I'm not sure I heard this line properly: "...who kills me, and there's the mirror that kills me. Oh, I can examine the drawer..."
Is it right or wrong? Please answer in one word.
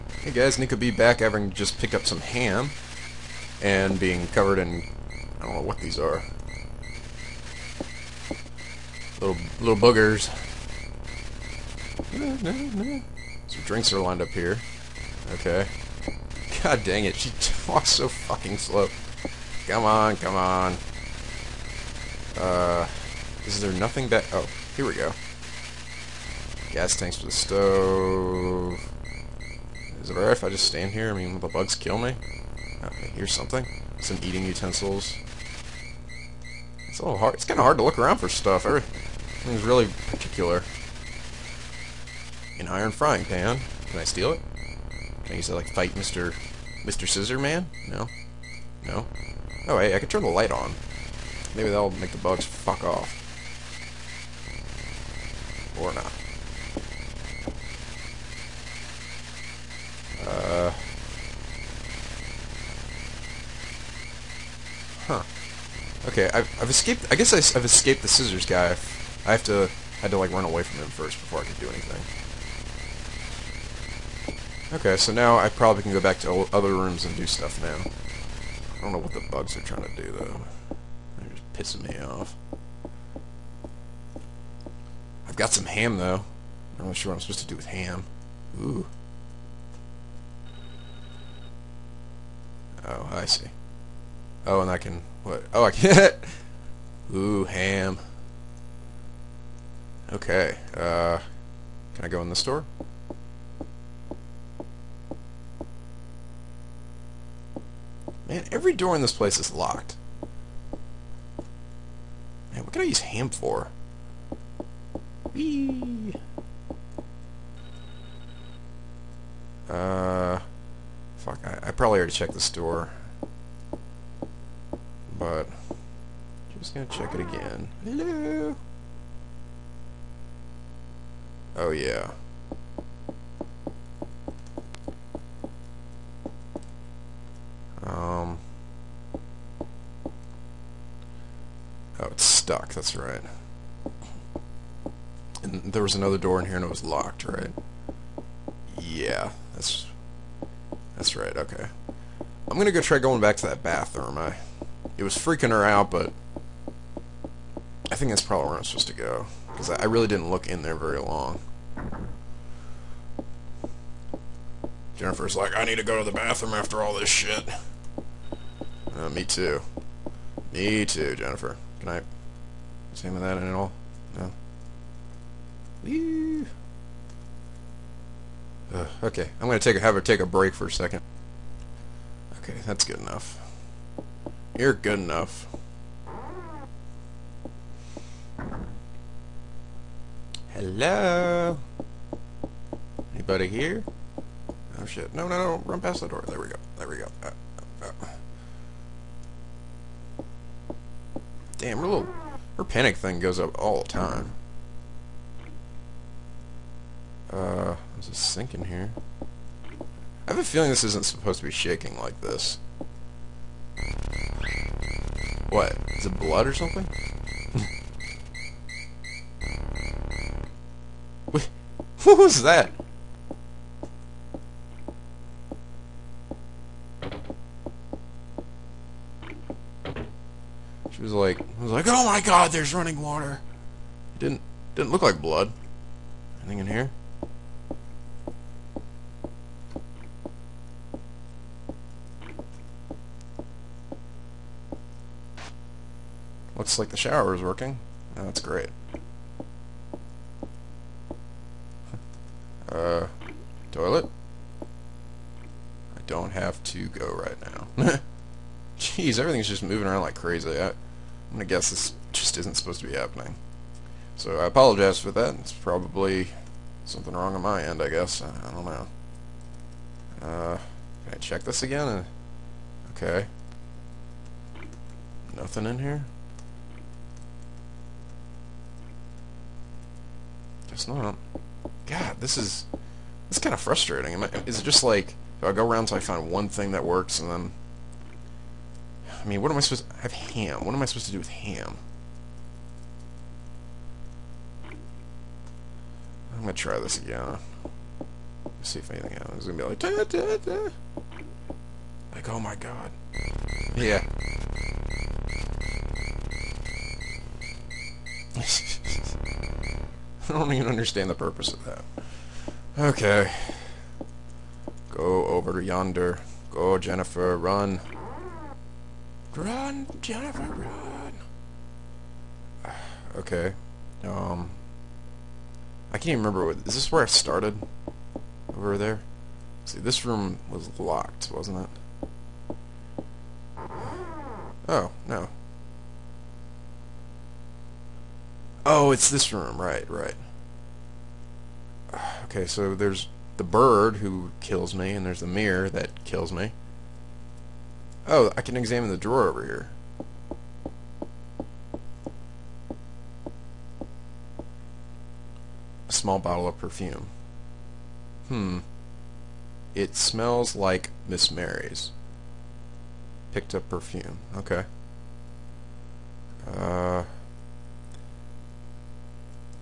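right.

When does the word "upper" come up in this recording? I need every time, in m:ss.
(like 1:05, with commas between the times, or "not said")
not said.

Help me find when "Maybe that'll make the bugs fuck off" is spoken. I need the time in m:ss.
0:51.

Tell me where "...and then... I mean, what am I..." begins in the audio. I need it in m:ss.
4:47.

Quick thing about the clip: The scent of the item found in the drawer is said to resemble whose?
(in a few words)
Miss Mary's.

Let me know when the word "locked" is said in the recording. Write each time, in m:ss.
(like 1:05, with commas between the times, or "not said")
1:49, 2:26, 5:30.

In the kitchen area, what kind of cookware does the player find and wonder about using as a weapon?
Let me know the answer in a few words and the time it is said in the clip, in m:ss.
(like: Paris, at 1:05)
Iron frying pan, at 0:42.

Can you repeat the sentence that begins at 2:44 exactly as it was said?
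Jennifer's like, I need to go to the bathroom after all this shit.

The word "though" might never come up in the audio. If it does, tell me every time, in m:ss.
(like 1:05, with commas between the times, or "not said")
1:20, 1:25.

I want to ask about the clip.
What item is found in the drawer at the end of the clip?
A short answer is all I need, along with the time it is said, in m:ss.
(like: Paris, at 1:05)
Small bottle of perfume, at 5:55.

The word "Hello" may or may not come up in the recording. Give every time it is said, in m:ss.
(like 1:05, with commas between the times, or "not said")
2:07, 3:10.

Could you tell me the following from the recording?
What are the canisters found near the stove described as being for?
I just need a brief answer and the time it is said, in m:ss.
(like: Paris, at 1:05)
Gas tanks, at 0:26.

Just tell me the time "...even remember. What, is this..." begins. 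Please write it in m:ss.
5:26.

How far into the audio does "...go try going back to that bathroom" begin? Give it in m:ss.
2:32.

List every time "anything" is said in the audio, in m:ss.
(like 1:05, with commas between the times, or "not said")
1:11, 3:56, 4:58.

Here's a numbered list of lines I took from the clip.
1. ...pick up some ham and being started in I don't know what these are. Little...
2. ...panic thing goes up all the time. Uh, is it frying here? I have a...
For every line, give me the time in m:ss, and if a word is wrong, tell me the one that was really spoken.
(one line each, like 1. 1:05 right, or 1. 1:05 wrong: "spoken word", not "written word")
1. 0:01 wrong: "covered", not "started"
2. 3:22 wrong: "sinking", not "frying".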